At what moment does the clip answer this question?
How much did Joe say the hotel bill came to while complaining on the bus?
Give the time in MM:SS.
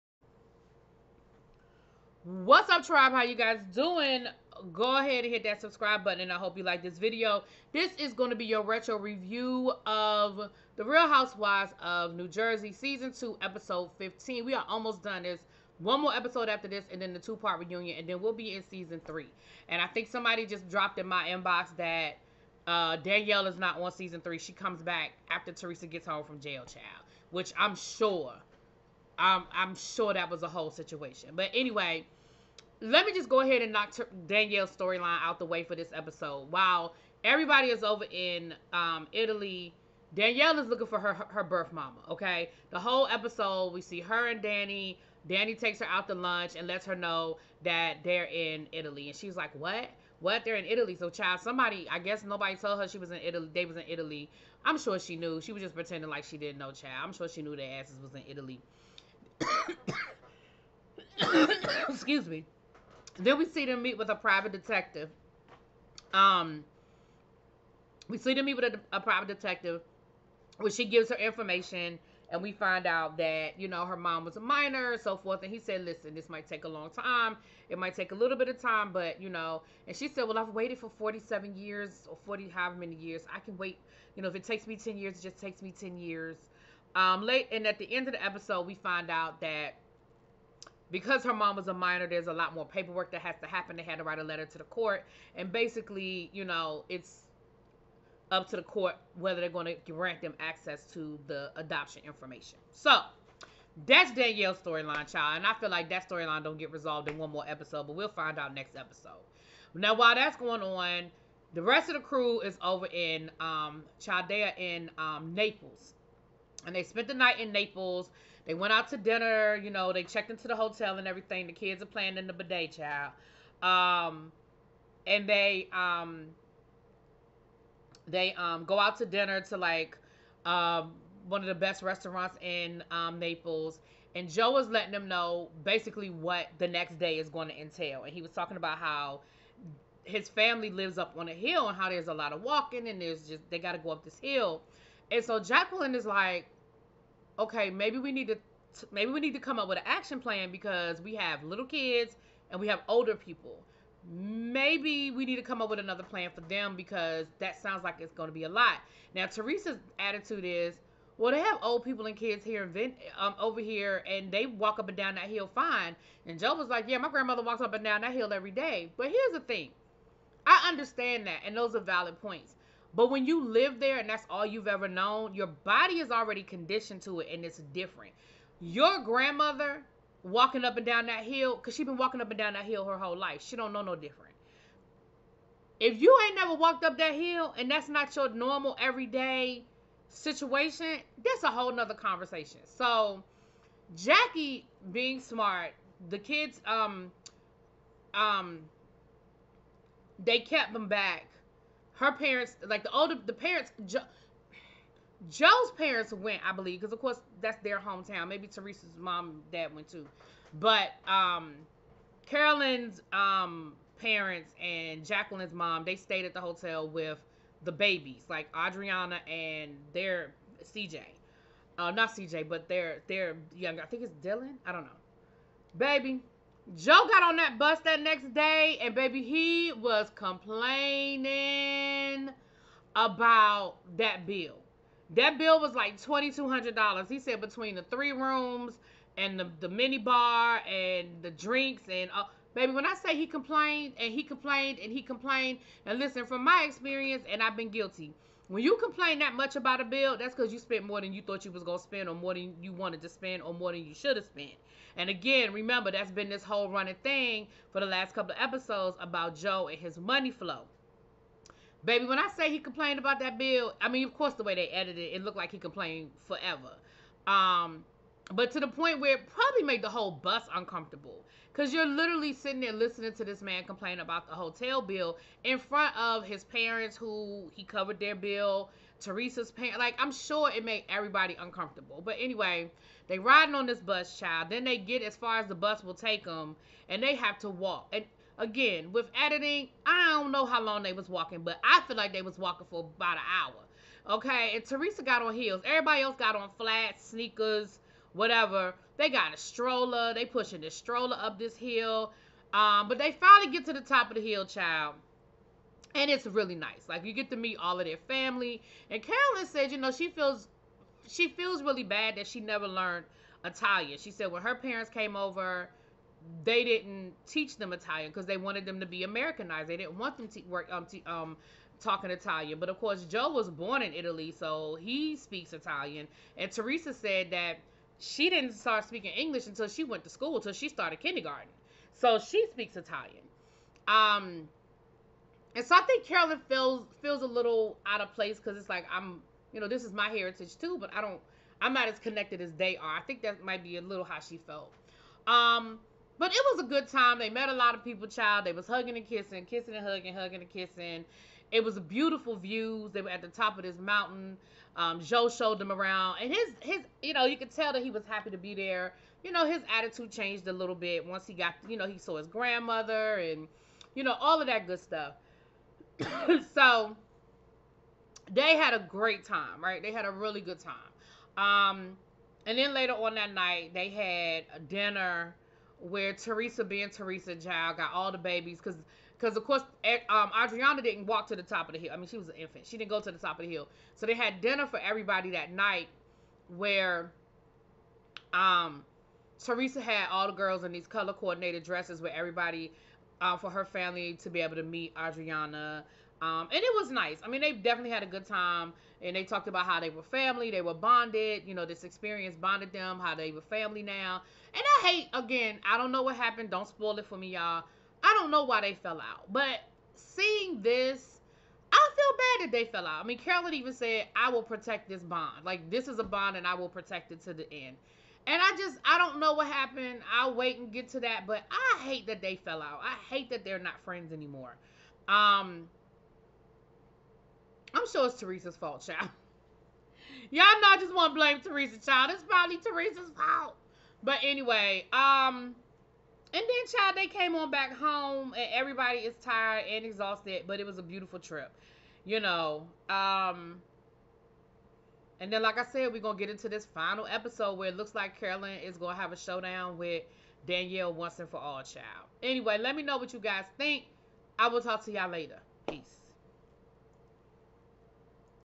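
03:55.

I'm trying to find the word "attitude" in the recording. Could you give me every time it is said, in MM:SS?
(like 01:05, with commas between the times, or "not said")
02:39, 05:59.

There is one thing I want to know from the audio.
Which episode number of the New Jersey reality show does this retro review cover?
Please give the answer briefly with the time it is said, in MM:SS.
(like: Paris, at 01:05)
15, at 00:13.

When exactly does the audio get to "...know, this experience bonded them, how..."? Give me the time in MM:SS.
06:41.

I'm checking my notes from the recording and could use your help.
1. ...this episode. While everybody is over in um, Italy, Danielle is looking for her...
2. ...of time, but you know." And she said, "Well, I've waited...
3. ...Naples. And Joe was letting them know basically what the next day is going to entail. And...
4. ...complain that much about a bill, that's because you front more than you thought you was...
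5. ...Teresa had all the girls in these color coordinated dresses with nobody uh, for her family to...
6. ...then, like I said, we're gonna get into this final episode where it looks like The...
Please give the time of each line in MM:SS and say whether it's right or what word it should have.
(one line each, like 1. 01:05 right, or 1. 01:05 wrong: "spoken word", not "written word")
1. 00:35 right
2. 01:18 right
3. 02:13 right
4. 04:08 wrong: "spent", not "front"
5. 06:29 wrong: "everybody", not "nobody"
6. 07:25 wrong: "Carolyn", not "The".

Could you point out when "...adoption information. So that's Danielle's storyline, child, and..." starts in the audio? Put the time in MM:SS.
01:41.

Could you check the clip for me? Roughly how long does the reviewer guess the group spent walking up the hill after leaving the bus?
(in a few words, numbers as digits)
about an hour.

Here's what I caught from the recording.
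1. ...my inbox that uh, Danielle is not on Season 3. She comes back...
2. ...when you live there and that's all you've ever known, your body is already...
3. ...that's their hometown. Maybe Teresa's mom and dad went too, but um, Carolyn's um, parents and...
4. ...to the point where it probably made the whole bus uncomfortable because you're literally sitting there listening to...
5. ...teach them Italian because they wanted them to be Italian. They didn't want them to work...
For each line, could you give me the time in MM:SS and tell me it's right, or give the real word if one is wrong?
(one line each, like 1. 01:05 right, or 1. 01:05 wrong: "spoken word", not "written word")
1. 00:21 right
2. 02:53 right
3. 03:27 right
4. 04:28 right
5. 05:17 wrong: "Americanized", not "Italian".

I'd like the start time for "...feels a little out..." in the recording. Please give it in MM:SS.
05:37.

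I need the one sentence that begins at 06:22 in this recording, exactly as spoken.
She didn't go to the top of the hill.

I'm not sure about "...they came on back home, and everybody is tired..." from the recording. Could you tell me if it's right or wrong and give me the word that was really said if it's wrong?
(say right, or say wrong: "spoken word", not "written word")
right.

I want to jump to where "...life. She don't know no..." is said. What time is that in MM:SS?
03:03.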